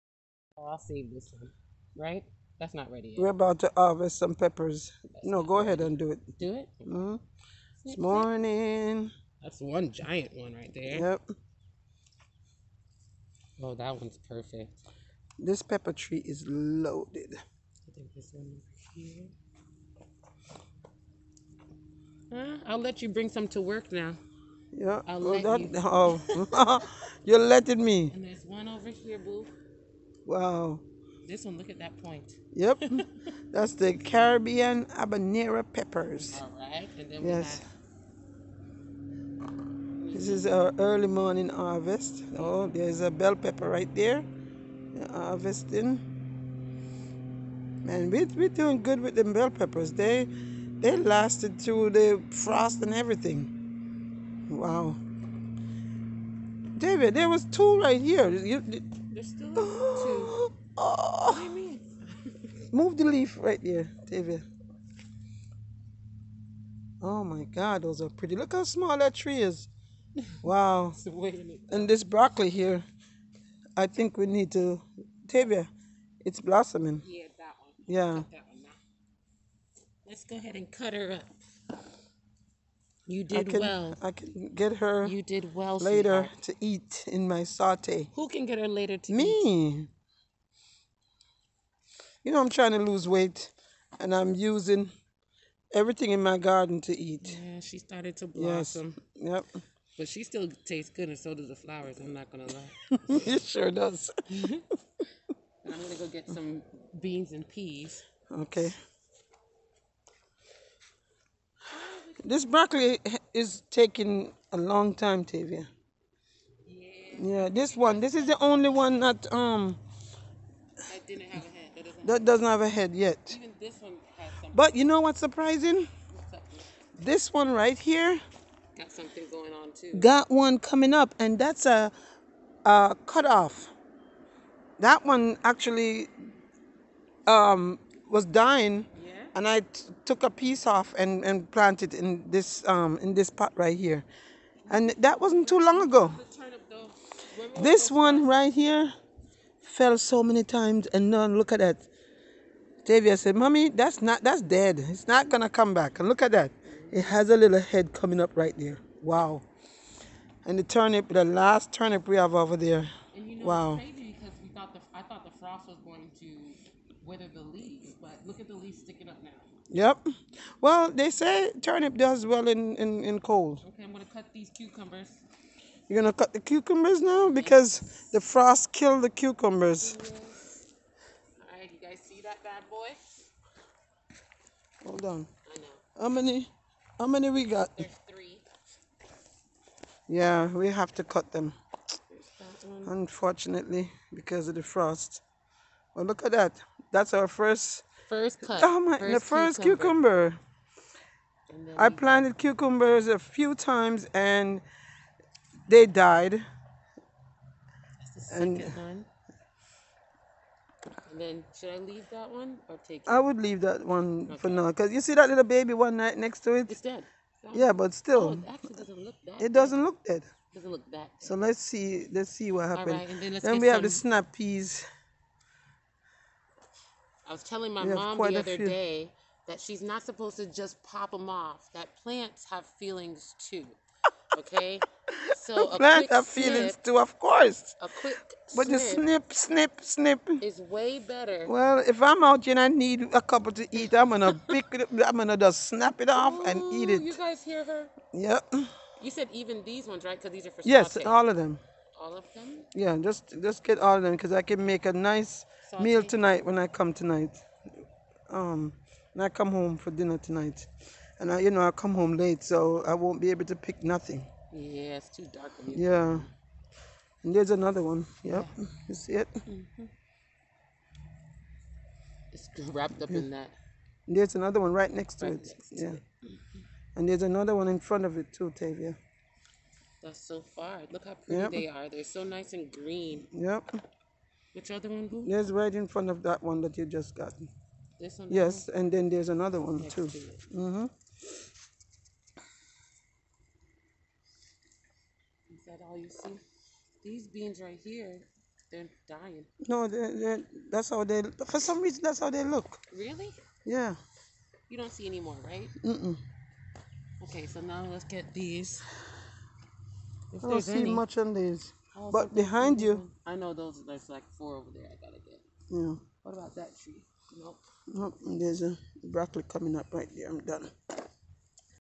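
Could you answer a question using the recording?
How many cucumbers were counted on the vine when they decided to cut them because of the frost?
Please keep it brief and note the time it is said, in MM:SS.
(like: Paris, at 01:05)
3, at 03:08.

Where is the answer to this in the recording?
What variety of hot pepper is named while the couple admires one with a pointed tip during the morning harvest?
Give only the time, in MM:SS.
00:33.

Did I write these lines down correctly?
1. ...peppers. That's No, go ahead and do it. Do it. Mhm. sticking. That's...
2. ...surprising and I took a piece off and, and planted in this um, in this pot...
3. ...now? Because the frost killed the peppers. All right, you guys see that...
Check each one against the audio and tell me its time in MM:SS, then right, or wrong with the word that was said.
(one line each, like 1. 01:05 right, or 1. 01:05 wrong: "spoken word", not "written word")
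1. 00:04 wrong: "morning", not "sticking"
2. 02:18 wrong: "dying", not "surprising"
3. 02:57 wrong: "cucumbers", not "peppers".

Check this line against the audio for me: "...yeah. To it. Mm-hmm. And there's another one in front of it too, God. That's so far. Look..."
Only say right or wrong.
wrong.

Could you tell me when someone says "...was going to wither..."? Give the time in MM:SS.
02:45.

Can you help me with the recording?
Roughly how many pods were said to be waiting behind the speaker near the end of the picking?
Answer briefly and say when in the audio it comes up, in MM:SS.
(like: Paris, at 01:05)
4, at 05:14.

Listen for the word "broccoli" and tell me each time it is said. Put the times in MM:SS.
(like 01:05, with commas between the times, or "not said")
01:12, 01:52, 05:19.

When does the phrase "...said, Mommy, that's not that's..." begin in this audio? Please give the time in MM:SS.
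02:33.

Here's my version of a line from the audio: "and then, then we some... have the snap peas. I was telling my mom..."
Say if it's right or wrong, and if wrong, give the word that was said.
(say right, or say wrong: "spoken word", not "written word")
right.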